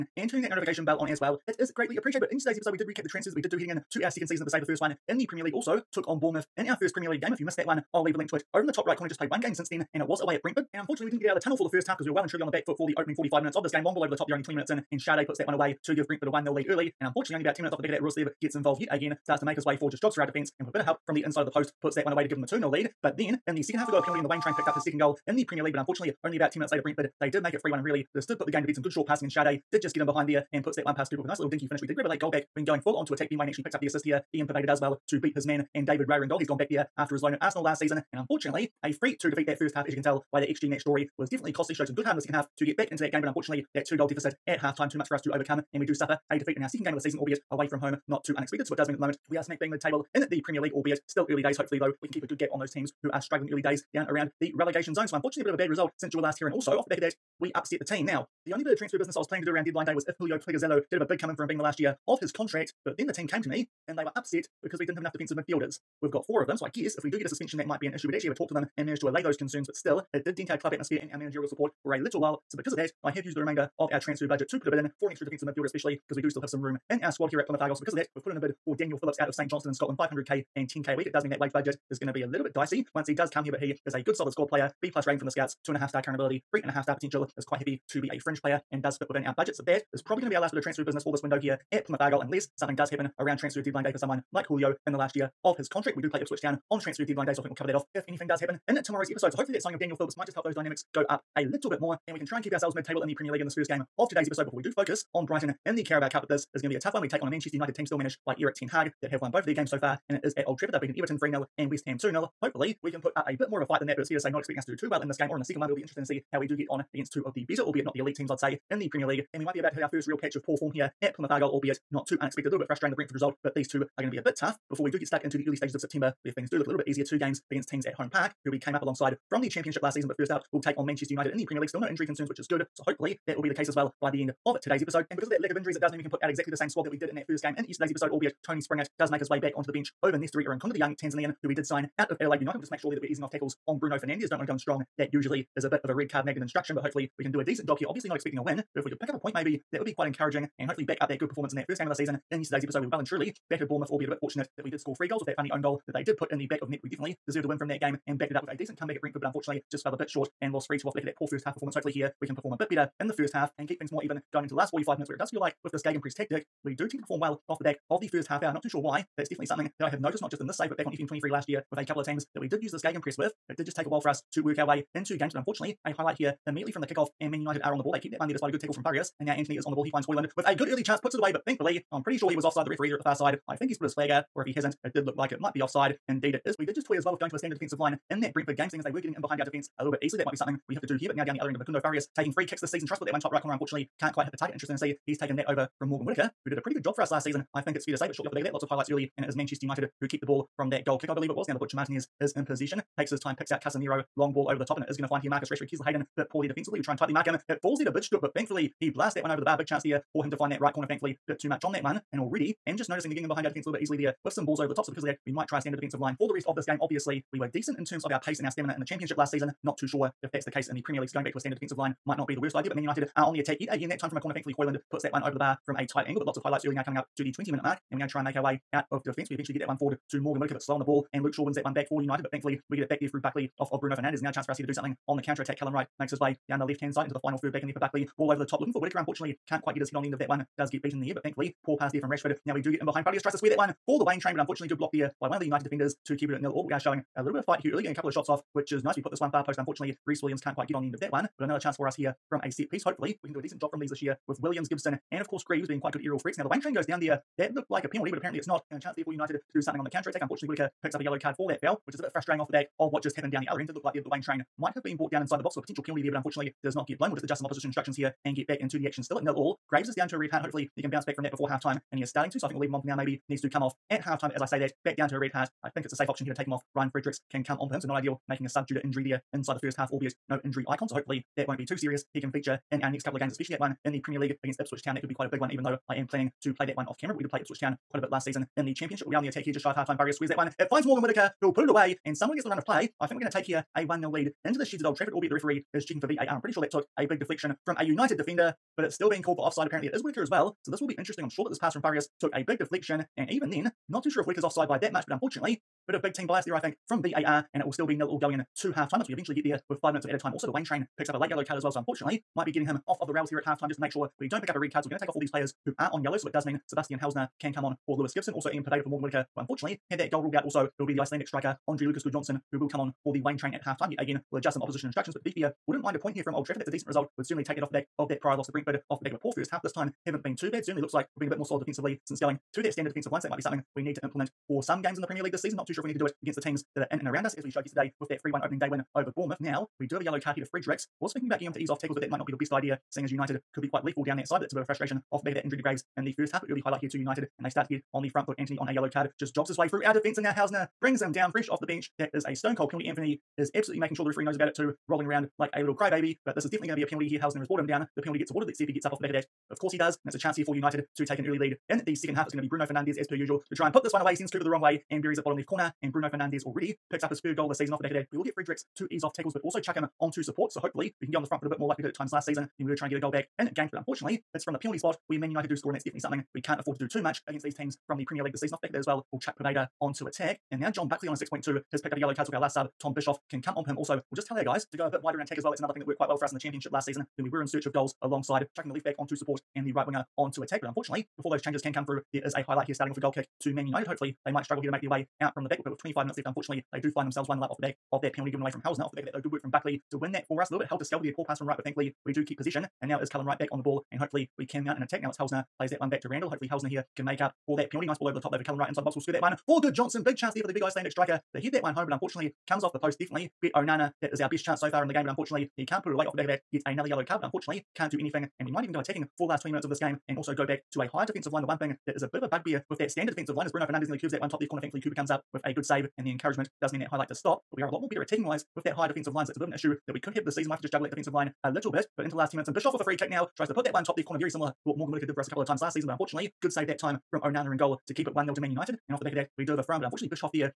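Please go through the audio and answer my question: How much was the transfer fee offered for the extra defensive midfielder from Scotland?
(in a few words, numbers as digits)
500k.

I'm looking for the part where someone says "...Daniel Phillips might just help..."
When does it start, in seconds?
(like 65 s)
99 s.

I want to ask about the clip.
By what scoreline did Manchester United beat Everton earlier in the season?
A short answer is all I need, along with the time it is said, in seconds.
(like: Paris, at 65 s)
3-0, at 111 s.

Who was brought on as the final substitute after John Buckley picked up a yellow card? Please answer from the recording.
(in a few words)
Tom Bischoff.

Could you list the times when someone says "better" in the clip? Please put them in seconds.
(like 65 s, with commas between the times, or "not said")
117 s, 153 s, 162 s, 427 s.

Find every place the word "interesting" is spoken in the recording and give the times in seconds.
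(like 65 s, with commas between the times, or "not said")
115 s, 194 s, 300 s.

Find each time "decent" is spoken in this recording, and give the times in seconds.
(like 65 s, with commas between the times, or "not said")
147 s, 158 s, 217 s, 253 s, 326 s.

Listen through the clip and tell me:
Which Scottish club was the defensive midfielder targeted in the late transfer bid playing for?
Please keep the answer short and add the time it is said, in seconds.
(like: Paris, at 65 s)
St Johnstone, at 79 s.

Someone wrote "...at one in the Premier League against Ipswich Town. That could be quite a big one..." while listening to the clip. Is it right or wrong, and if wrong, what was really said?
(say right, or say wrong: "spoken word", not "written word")
right.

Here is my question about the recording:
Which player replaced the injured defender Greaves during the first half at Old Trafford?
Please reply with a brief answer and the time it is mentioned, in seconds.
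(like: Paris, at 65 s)
Ryan Fredericks, at 276 s.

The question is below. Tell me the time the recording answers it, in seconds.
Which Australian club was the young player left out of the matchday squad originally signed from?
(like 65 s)
142 s.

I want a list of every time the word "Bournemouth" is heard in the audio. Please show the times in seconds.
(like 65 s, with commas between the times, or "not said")
6 s, 153 s, 339 s.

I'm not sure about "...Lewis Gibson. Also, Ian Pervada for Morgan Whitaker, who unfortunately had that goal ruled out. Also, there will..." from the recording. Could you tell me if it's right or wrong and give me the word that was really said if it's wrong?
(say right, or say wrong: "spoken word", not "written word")
right.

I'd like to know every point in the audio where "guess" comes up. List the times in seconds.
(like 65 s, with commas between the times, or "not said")
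66 s.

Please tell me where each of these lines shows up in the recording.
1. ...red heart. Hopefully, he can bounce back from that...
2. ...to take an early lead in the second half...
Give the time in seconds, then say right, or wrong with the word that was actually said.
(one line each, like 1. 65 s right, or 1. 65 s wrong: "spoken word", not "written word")
1. 270 s right
2. 360 s right.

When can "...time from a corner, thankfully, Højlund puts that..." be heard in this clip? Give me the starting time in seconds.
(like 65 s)
223 s.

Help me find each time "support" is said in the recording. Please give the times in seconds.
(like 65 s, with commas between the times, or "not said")
71 s, 370 s, 389 s.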